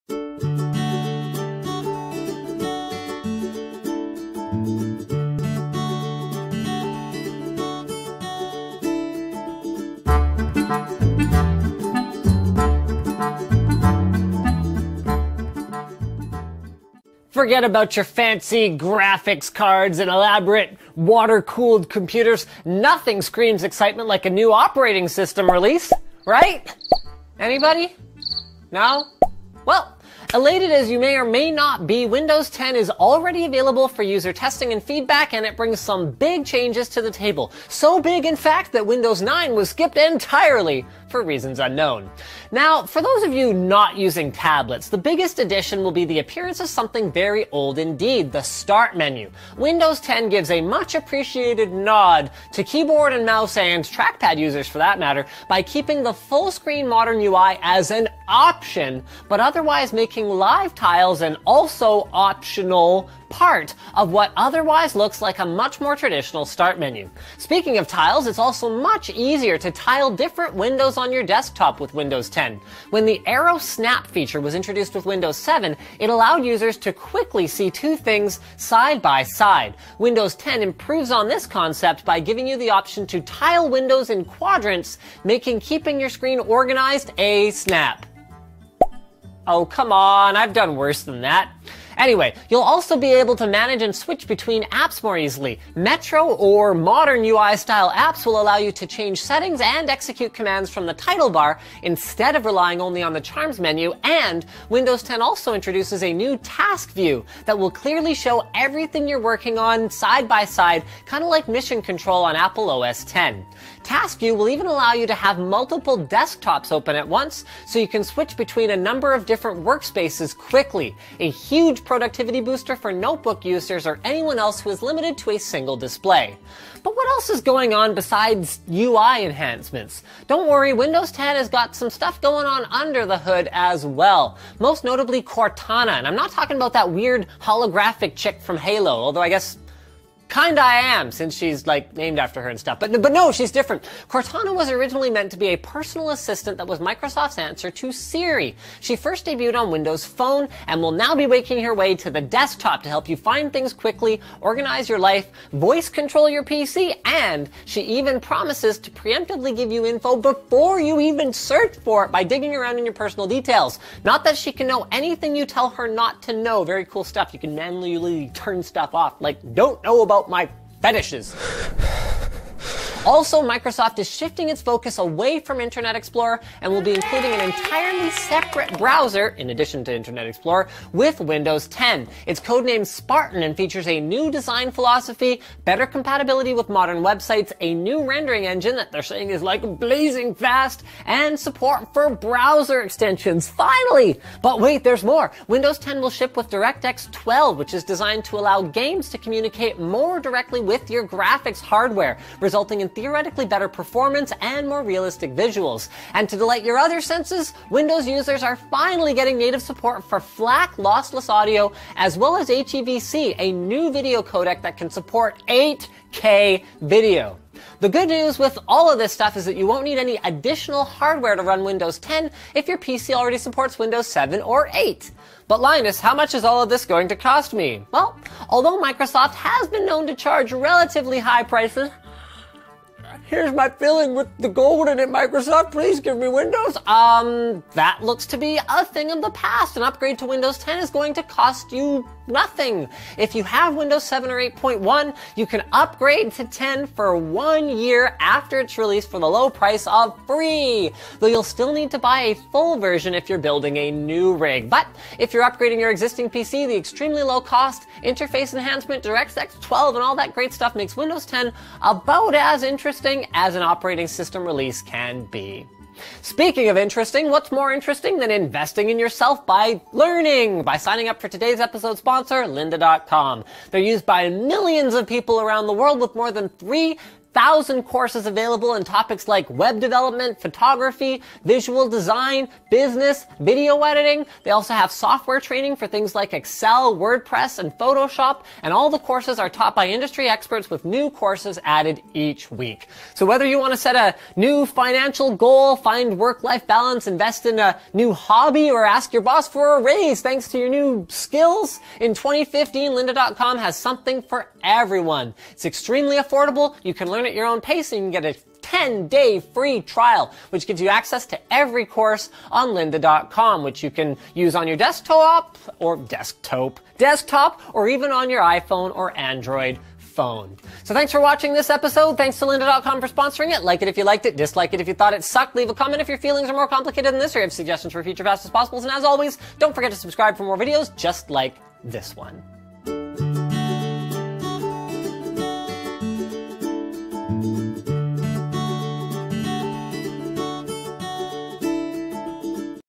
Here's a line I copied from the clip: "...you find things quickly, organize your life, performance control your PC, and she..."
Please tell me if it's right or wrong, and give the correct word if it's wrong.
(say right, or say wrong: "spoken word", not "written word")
wrong: "voice", not "performance".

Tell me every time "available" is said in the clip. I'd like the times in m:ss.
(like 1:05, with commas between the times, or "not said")
0:33, 4:38.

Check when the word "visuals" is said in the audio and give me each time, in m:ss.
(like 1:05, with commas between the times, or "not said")
3:25, 4:41.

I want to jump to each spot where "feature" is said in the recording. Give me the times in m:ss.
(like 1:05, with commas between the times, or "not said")
1:14, 3:03.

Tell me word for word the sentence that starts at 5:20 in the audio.
So thanks for watching this episode.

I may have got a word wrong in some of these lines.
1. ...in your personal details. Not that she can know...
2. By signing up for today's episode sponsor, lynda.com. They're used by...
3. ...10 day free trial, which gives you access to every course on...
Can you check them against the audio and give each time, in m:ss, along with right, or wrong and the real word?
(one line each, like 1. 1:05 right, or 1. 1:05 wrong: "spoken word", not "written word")
1. 2:42 right
2. 4:30 right
3. 5:08 right.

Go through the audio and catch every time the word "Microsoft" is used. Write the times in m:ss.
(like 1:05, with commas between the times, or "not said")
2:26, 2:53, 3:48, 3:55.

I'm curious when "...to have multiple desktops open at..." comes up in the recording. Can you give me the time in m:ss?
1:55.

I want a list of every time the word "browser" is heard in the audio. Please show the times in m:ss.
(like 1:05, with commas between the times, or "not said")
2:58, 3:12.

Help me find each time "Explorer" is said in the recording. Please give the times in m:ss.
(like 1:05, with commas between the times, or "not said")
2:55, 3:00.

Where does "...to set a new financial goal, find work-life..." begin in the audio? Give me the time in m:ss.
4:53.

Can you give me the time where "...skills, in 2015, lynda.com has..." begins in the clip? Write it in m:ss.
5:01.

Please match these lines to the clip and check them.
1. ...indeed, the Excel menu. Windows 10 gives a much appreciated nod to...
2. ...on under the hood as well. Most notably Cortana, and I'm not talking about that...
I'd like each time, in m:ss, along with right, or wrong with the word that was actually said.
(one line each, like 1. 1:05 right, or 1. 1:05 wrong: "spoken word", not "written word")
1. 0:47 wrong: "Start", not "Excel"
2. 2:12 right.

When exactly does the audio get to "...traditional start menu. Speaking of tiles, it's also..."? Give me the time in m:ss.
1:05.